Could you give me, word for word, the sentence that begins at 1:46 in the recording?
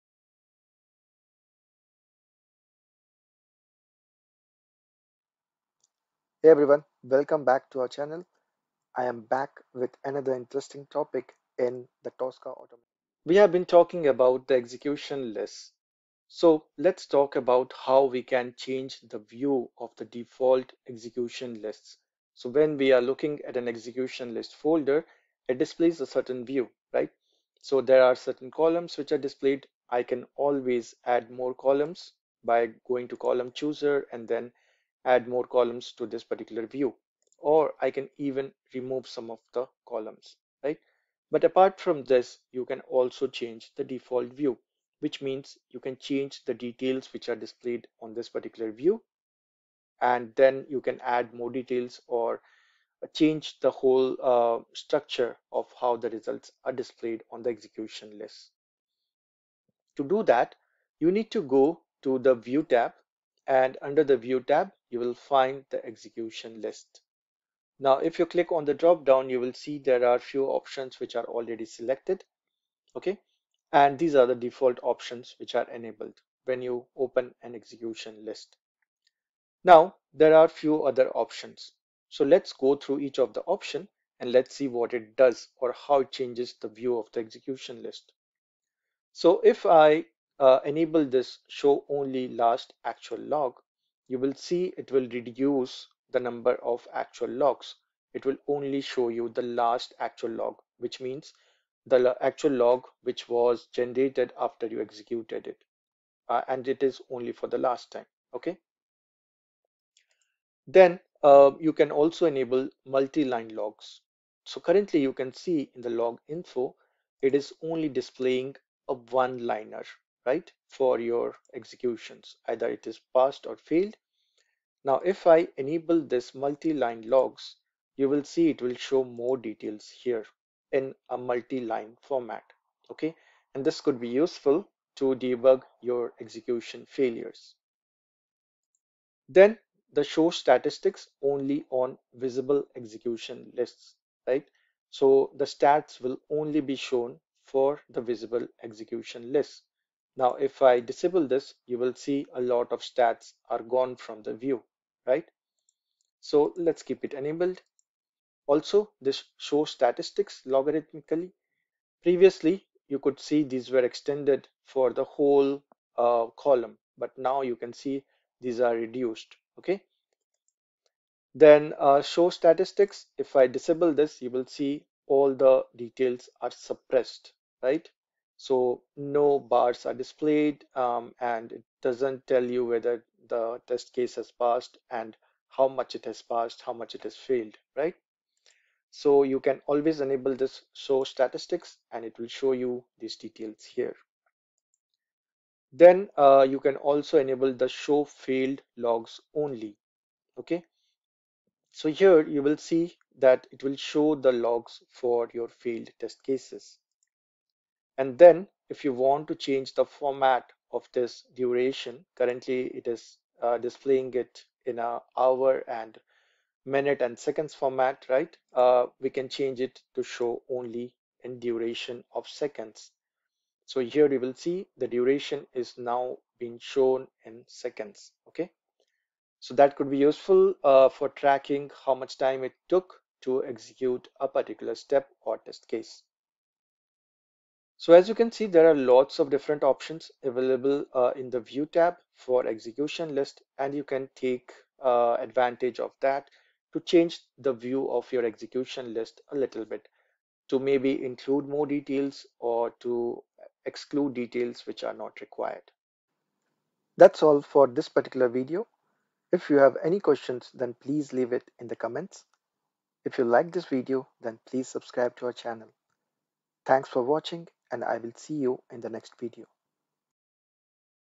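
Uh, and it is only for the last time, okay?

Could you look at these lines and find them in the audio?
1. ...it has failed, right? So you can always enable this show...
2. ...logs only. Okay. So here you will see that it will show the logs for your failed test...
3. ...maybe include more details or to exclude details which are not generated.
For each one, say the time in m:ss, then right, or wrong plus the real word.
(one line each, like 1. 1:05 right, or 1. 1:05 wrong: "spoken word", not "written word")
1. 3:06 right
2. 3:18 right
3. 4:10 wrong: "required", not "generated".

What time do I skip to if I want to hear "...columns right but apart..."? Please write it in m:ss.
0:39.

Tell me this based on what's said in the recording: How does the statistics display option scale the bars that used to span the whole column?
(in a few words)
logarithmically.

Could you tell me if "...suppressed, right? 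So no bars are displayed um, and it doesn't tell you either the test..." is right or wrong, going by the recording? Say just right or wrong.
wrong.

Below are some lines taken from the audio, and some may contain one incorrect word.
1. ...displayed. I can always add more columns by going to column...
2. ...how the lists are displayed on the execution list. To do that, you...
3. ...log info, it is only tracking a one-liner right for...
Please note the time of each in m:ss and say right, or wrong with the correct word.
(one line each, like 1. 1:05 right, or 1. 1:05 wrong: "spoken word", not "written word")
1. 0:29 right
2. 0:55 wrong: "results", not "lists"
3. 1:55 wrong: "displaying", not "tracking".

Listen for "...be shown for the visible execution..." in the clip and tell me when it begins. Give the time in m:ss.
2:26.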